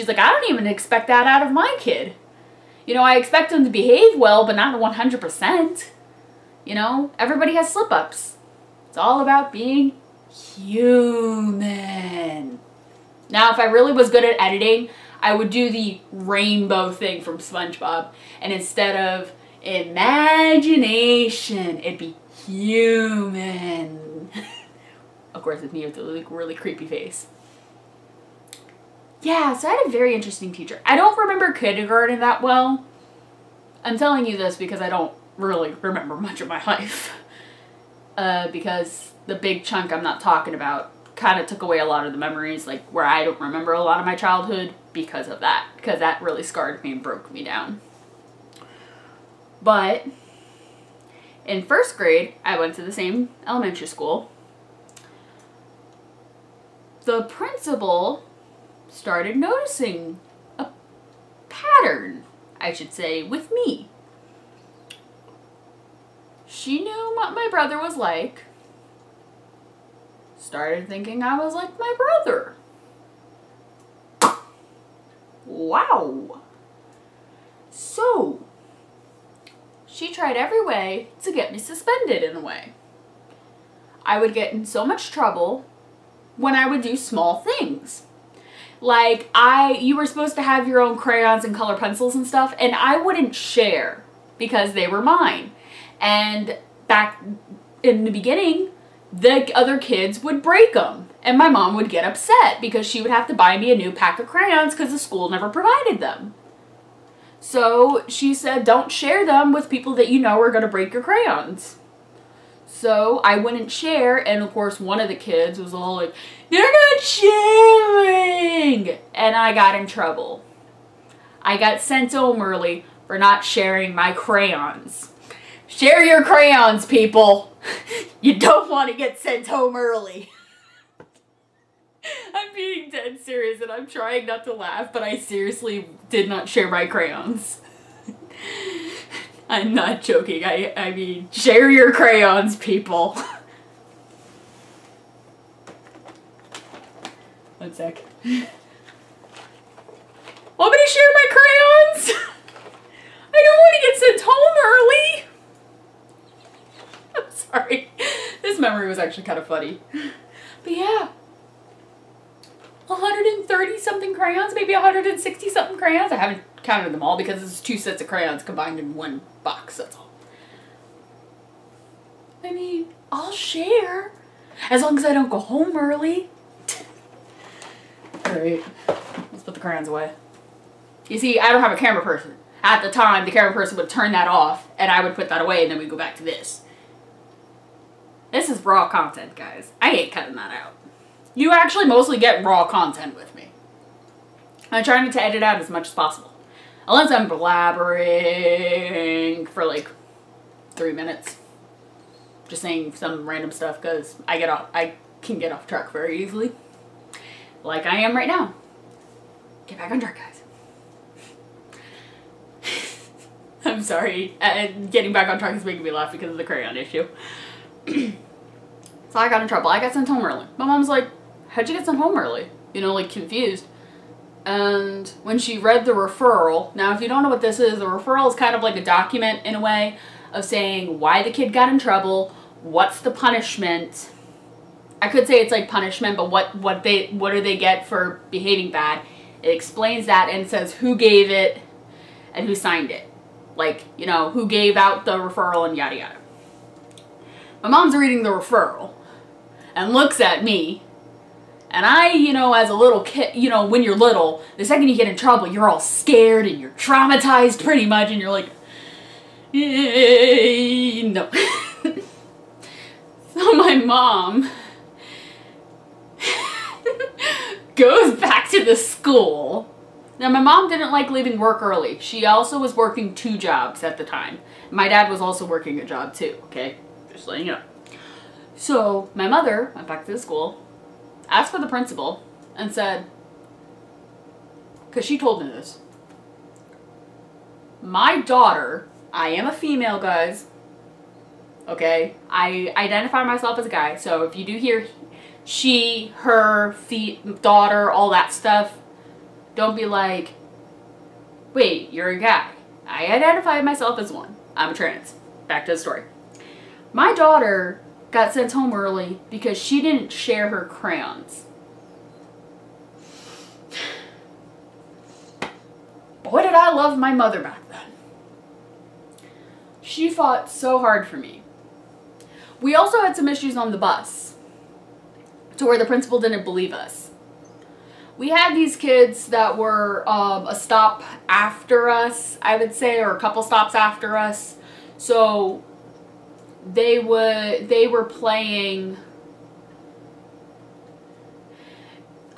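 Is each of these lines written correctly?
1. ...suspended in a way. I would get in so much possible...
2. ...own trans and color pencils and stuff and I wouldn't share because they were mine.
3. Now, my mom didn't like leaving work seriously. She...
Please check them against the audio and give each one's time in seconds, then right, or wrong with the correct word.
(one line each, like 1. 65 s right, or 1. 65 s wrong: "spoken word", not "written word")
1. 81 s wrong: "trouble", not "possible"
2. 90 s wrong: "crayons", not "trans"
3. 270 s wrong: "early", not "seriously".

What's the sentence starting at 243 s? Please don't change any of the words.
Like, you know, who gave out the referral and yada yada.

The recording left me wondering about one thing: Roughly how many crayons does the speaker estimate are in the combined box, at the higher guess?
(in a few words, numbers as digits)
160.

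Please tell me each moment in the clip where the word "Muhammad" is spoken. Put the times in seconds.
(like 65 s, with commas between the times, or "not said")
not said.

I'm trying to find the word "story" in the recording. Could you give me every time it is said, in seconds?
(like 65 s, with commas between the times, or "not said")
305 s.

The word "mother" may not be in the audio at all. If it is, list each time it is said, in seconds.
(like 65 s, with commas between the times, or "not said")
279 s, 317 s.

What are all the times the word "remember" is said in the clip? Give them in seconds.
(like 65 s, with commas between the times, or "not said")
31 s, 35 s, 43 s.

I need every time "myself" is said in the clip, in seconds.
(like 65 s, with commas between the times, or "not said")
293 s, 303 s.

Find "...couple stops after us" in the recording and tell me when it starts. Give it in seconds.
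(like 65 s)
333 s.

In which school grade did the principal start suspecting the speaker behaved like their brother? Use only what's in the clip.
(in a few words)
First grade.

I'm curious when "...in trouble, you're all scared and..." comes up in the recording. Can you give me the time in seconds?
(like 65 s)
255 s.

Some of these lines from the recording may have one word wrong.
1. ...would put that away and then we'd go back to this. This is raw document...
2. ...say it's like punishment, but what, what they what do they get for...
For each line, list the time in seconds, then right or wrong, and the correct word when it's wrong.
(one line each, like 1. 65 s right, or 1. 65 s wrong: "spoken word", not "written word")
1. 185 s wrong: "content", not "document"
2. 235 s right.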